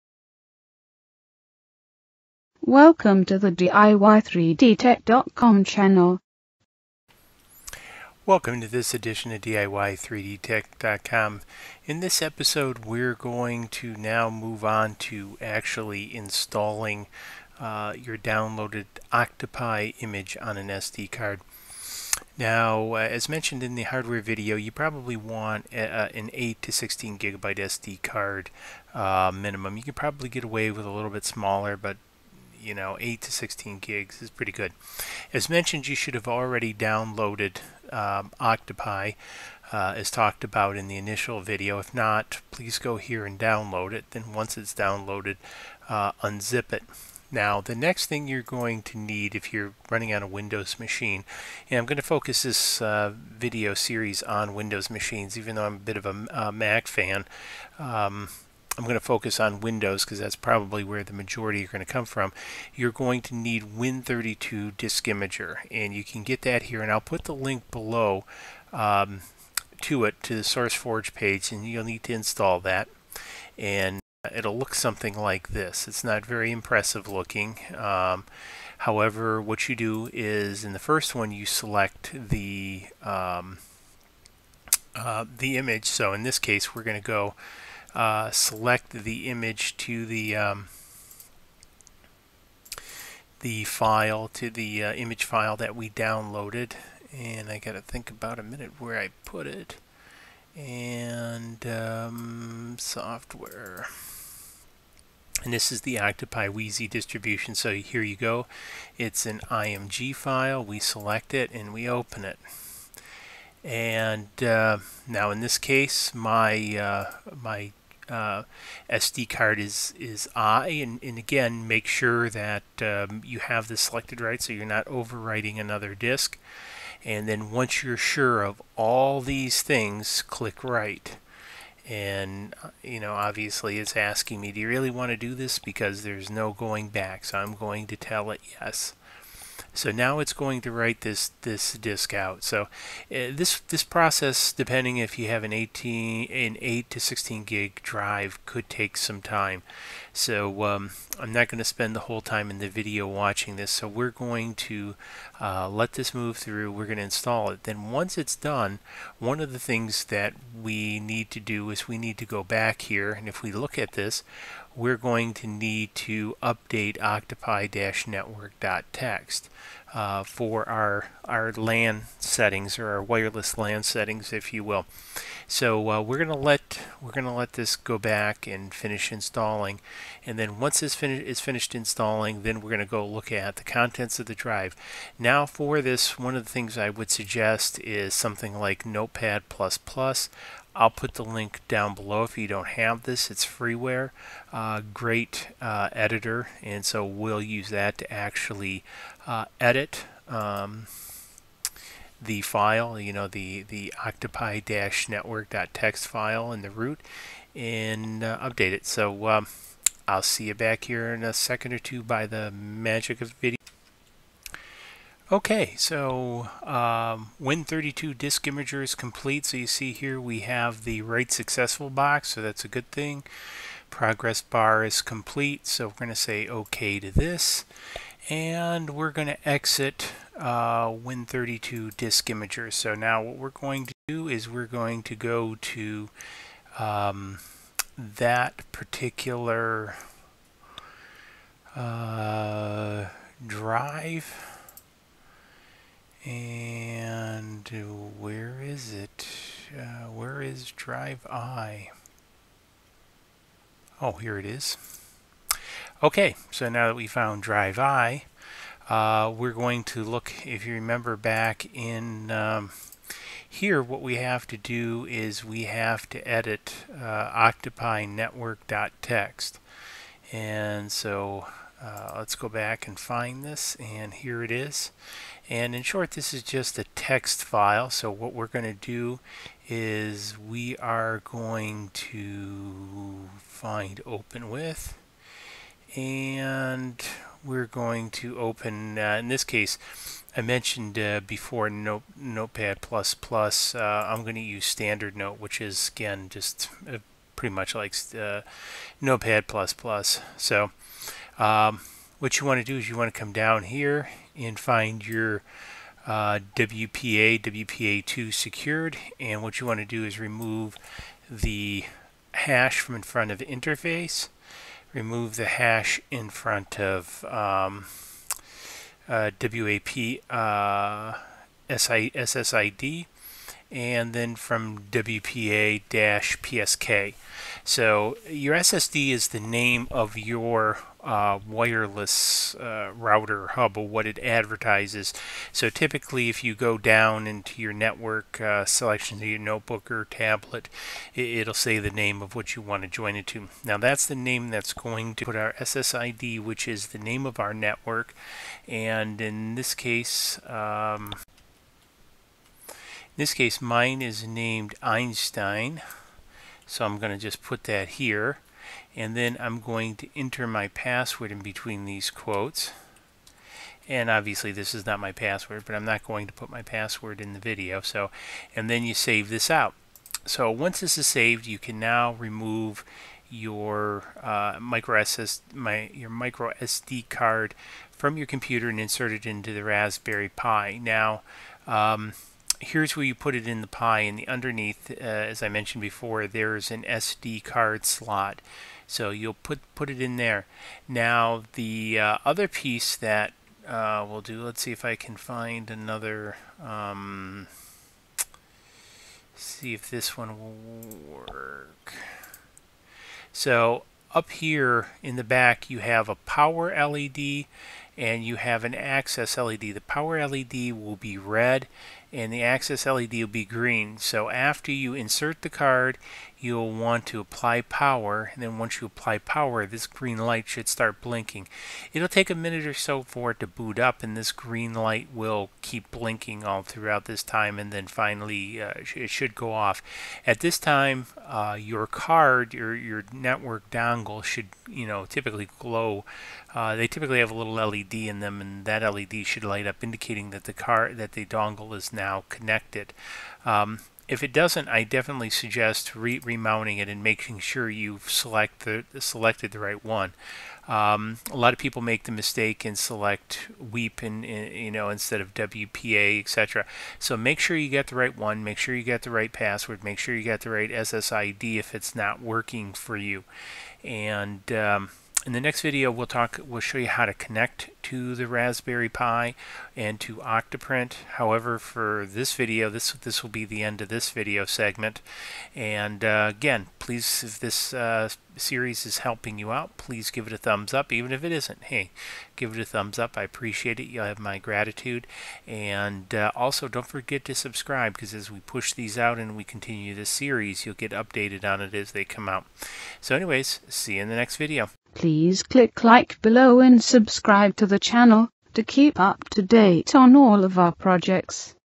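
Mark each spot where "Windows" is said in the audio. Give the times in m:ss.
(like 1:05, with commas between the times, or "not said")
0:50, 0:54, 0:59.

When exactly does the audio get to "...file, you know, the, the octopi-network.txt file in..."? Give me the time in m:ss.
3:22.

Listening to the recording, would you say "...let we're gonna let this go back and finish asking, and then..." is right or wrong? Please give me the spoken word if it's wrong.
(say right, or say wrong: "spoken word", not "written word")
wrong: "installing", not "asking".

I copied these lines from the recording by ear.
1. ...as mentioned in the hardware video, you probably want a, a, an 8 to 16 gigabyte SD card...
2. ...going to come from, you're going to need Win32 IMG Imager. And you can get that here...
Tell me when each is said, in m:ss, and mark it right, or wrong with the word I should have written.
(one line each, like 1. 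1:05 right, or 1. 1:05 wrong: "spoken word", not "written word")
1. 0:22 right
2. 1:01 wrong: "Disk", not "IMG".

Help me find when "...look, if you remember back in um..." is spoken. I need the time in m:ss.
4:20.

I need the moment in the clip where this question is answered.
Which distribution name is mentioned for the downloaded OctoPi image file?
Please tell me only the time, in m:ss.
1:46.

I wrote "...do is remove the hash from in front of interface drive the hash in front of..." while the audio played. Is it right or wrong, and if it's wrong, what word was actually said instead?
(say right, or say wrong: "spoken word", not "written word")
wrong: "remove", not "drive".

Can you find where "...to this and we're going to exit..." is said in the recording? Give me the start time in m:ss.
3:46.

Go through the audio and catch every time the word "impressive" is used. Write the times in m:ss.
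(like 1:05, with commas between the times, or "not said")
1:16.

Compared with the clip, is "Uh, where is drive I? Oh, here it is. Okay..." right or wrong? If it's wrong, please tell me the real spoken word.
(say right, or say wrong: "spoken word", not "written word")
right.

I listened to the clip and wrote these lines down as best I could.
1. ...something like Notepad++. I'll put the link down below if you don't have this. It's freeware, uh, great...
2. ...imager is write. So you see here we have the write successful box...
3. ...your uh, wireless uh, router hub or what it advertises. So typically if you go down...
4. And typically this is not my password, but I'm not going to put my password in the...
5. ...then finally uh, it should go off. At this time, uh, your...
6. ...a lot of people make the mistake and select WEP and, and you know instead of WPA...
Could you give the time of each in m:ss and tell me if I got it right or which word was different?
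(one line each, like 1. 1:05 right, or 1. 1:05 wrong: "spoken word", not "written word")
1. 3:08 right
2. 3:38 wrong: "complete", not "write"
3. 5:30 right
4. 6:03 wrong: "obviously", not "typically"
5. 7:07 right
6. 7:31 right.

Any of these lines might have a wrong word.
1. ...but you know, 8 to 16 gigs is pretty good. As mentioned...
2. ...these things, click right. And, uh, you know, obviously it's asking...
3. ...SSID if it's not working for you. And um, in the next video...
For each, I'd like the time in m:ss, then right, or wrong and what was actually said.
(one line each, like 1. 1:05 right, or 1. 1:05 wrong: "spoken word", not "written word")
1. 0:31 right
2. 2:09 right
3. 7:40 right.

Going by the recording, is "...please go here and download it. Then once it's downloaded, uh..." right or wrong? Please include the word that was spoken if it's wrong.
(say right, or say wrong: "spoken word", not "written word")
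right.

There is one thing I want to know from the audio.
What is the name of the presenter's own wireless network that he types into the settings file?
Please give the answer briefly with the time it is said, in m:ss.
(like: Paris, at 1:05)
Einstein, at 5:54.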